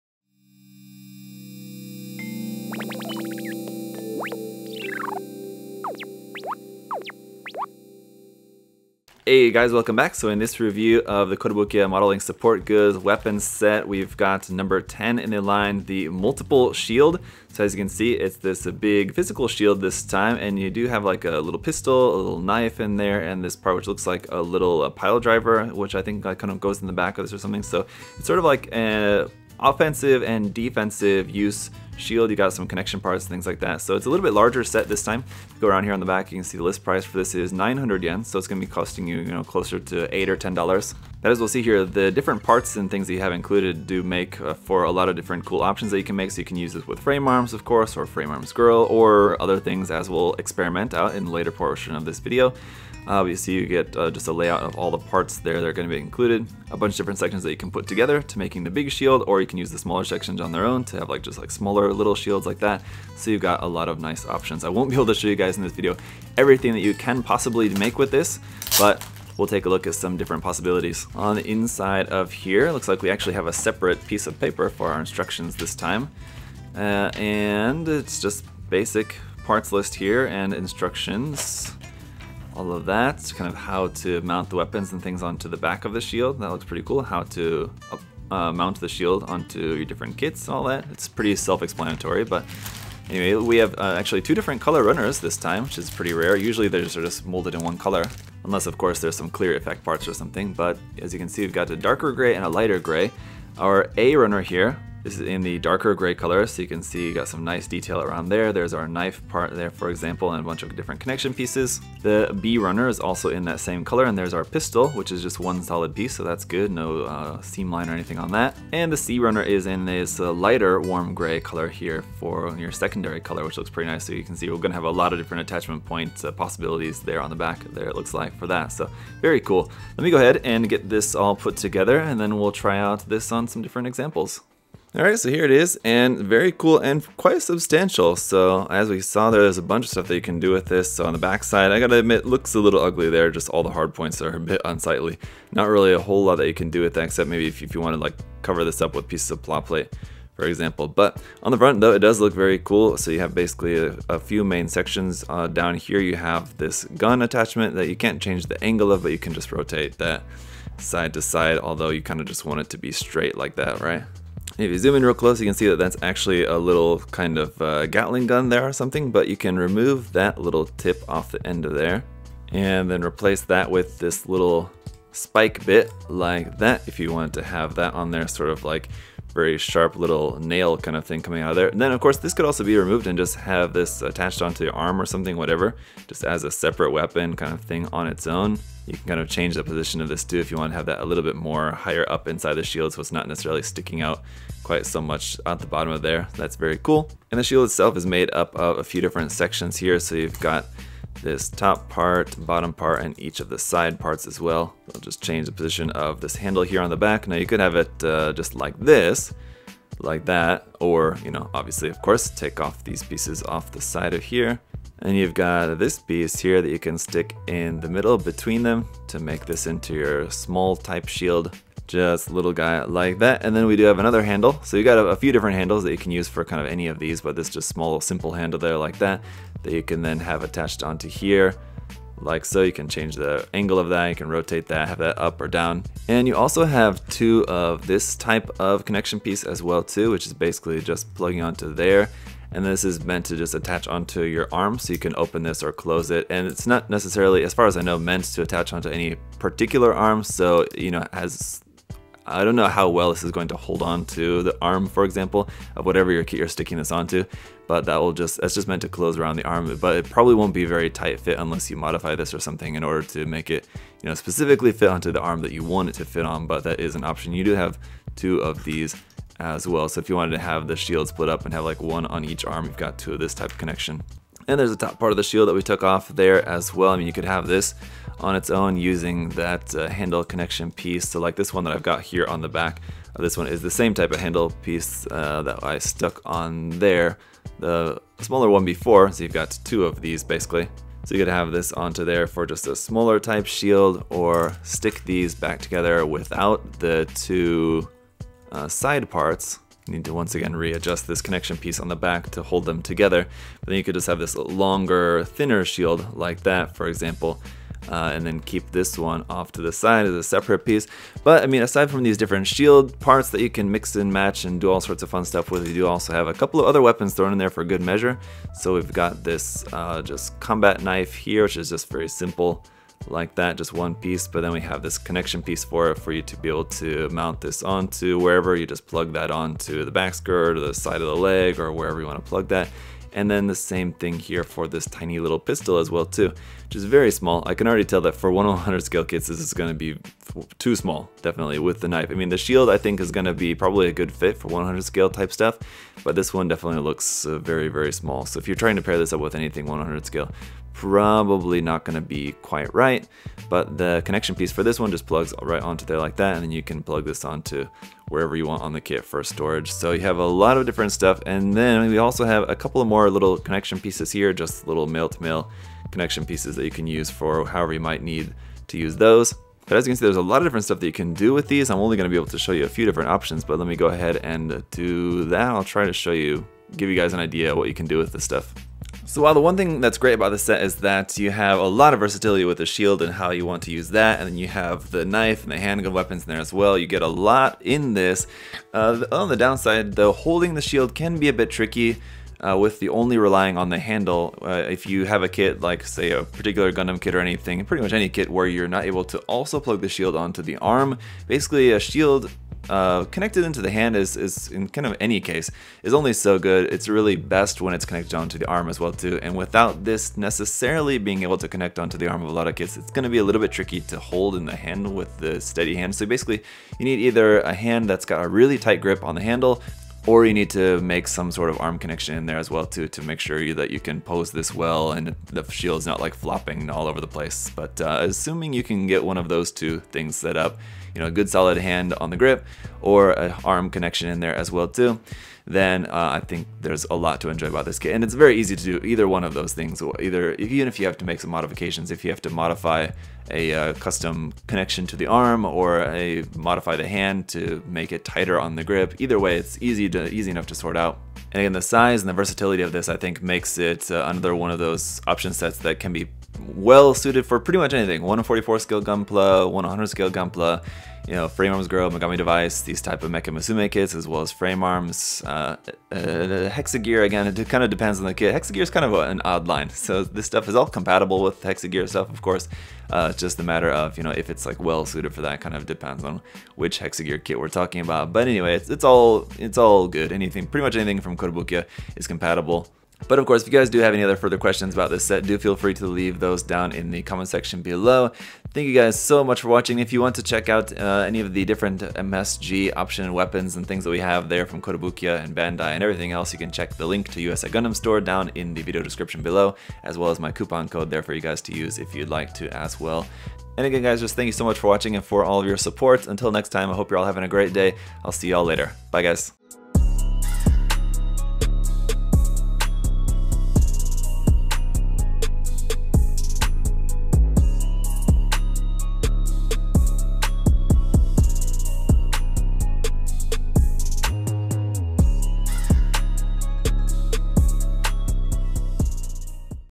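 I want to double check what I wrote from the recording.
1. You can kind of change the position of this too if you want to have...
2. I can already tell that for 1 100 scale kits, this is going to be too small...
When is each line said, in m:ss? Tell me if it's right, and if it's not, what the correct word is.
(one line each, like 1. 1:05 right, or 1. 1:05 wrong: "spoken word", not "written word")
1. 3:08 right
2. 5:37 right.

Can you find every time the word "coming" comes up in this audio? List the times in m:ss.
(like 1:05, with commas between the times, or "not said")
3:01.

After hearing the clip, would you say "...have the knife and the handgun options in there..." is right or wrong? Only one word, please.
wrong.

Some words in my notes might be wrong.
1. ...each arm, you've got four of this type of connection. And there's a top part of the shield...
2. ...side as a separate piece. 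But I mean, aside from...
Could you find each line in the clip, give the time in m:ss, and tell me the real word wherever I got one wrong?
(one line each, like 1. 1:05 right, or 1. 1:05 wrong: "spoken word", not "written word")
1. 4:32 wrong: "two", not "four"
2. 5:09 right.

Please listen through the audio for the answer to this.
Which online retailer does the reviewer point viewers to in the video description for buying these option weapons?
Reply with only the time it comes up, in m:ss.
8:17.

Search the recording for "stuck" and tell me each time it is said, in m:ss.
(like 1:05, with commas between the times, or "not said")
4:45.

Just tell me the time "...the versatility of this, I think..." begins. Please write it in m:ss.
7:32.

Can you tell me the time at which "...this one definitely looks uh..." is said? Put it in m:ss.
5:46.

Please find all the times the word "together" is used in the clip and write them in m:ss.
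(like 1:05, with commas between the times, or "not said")
0:57, 2:11, 4:55, 5:02.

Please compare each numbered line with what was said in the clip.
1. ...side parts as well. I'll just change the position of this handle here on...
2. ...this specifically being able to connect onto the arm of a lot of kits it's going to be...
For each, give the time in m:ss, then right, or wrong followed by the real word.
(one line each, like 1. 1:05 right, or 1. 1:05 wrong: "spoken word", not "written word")
1. 3:23 right
2. 6:49 wrong: "necessarily", not "specifically".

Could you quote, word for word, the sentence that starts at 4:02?
And this is meant to just attach onto your arm so you can open this or close it.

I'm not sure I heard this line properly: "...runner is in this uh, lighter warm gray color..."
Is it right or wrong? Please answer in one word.
right.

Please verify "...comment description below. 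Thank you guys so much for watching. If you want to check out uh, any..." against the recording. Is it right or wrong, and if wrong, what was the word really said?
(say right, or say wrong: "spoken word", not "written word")
wrong: "section", not "description".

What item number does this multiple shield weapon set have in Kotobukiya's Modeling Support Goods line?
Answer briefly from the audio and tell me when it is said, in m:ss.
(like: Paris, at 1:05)
10, at 0:14.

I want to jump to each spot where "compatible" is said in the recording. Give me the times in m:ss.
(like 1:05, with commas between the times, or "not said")
7:50, 8:02.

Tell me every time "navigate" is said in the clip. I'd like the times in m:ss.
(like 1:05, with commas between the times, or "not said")
not said.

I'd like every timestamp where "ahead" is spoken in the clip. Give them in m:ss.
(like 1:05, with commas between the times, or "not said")
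2:10, 6:13.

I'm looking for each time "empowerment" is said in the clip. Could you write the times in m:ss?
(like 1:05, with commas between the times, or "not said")
not said.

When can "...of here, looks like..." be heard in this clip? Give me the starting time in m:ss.
1:12.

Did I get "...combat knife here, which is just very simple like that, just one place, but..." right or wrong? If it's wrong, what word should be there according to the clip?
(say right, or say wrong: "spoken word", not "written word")
wrong: "piece", not "place".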